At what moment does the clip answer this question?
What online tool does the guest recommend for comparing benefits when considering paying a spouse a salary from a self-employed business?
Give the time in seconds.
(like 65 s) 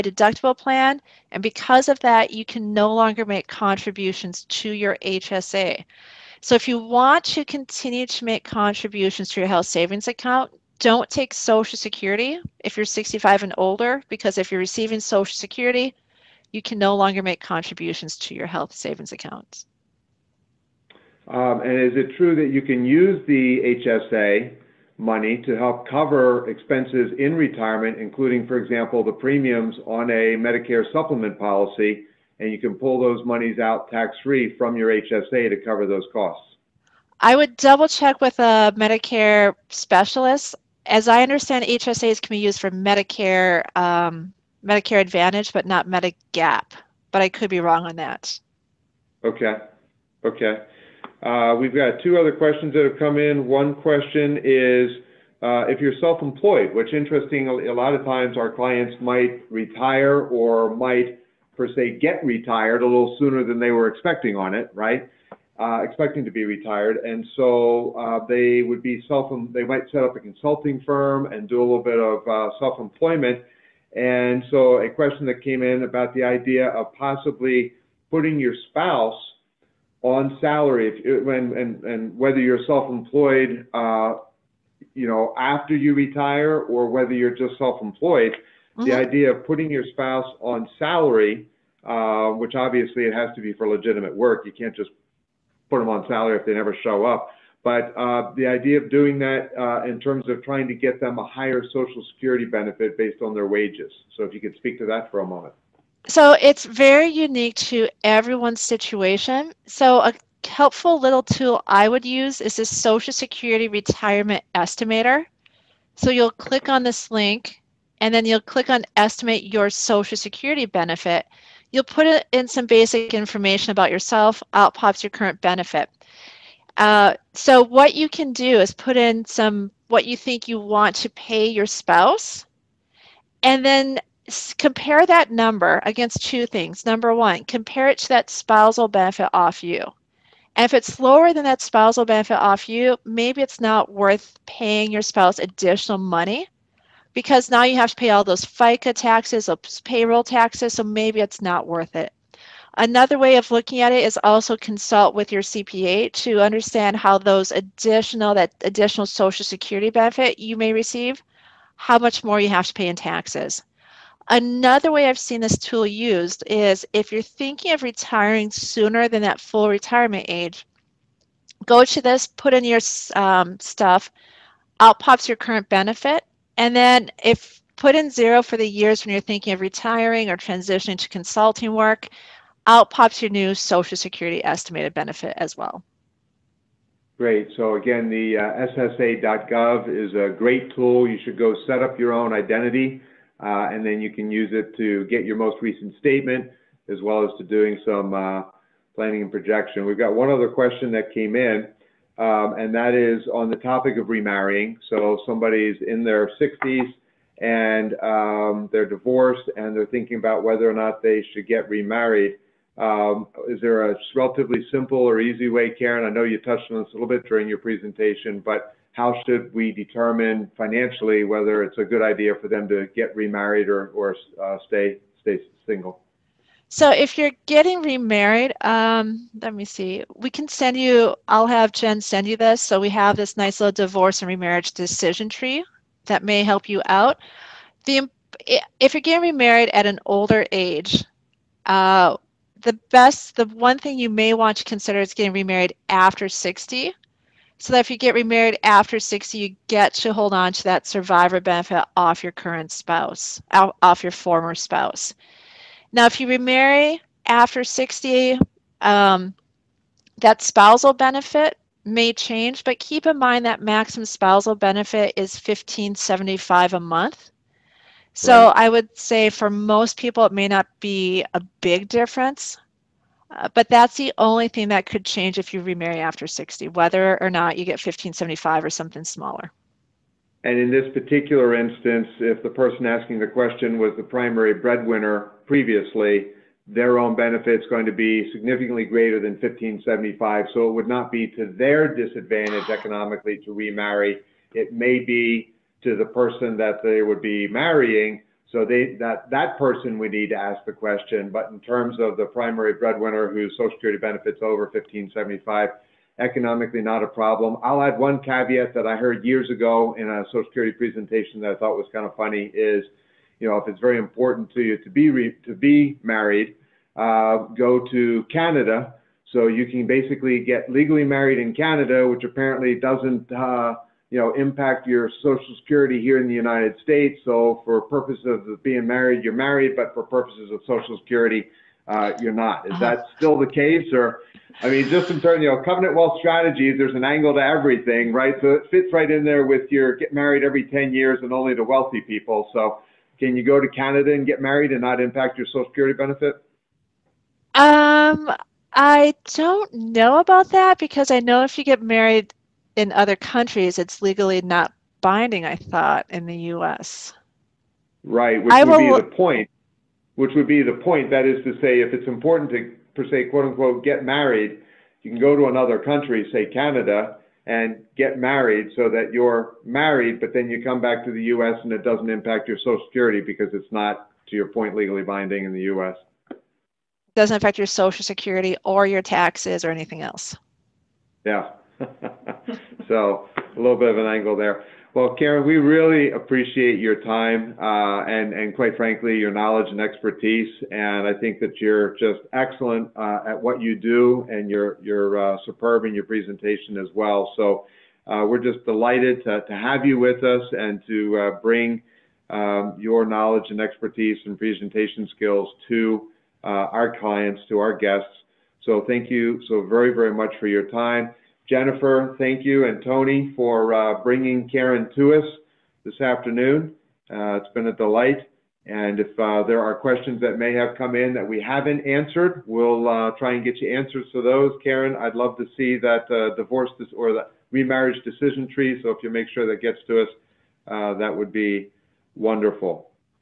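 112 s.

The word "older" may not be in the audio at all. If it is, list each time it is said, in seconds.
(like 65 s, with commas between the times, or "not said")
13 s, 240 s.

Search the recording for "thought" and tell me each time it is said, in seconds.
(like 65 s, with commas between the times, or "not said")
311 s, 355 s.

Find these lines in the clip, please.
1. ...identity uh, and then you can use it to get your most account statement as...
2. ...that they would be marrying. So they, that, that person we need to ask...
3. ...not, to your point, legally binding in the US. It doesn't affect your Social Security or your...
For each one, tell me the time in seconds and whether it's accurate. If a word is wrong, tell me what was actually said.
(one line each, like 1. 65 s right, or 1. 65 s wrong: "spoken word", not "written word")
1. 192 s wrong: "recent", not "account"
2. 296 s right
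3. 373 s right.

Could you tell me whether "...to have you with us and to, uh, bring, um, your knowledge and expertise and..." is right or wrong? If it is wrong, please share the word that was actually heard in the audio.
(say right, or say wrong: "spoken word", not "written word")
right.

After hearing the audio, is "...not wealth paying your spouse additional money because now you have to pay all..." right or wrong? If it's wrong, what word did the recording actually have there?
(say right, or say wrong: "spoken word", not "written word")
wrong: "worth", not "wealth".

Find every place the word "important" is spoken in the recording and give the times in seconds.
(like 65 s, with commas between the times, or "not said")
313 s, 362 s.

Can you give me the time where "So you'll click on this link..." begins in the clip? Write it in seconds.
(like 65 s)
115 s.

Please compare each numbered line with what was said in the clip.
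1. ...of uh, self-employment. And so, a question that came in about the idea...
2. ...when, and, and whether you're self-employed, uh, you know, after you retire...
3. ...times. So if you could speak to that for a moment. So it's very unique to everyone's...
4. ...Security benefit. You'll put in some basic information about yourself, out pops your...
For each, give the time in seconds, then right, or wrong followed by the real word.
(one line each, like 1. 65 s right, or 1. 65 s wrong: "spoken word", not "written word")
1. 71 s right
2. 81 s right
3. 103 s wrong: "wages", not "times"
4. 120 s right.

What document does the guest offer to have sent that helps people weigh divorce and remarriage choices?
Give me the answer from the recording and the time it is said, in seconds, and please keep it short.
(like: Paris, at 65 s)
divorce and remarriage decision tree, at 233 s.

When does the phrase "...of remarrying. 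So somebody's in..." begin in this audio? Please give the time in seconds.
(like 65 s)
203 s.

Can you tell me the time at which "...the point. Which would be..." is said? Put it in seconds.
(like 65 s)
359 s.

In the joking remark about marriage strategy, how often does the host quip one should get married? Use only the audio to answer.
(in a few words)
every 10 years.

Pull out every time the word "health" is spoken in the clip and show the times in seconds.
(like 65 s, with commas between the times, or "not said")
9 s, 18 s.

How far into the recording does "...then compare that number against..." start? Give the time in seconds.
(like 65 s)
133 s.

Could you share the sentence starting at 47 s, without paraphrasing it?
But I could be wrong on that.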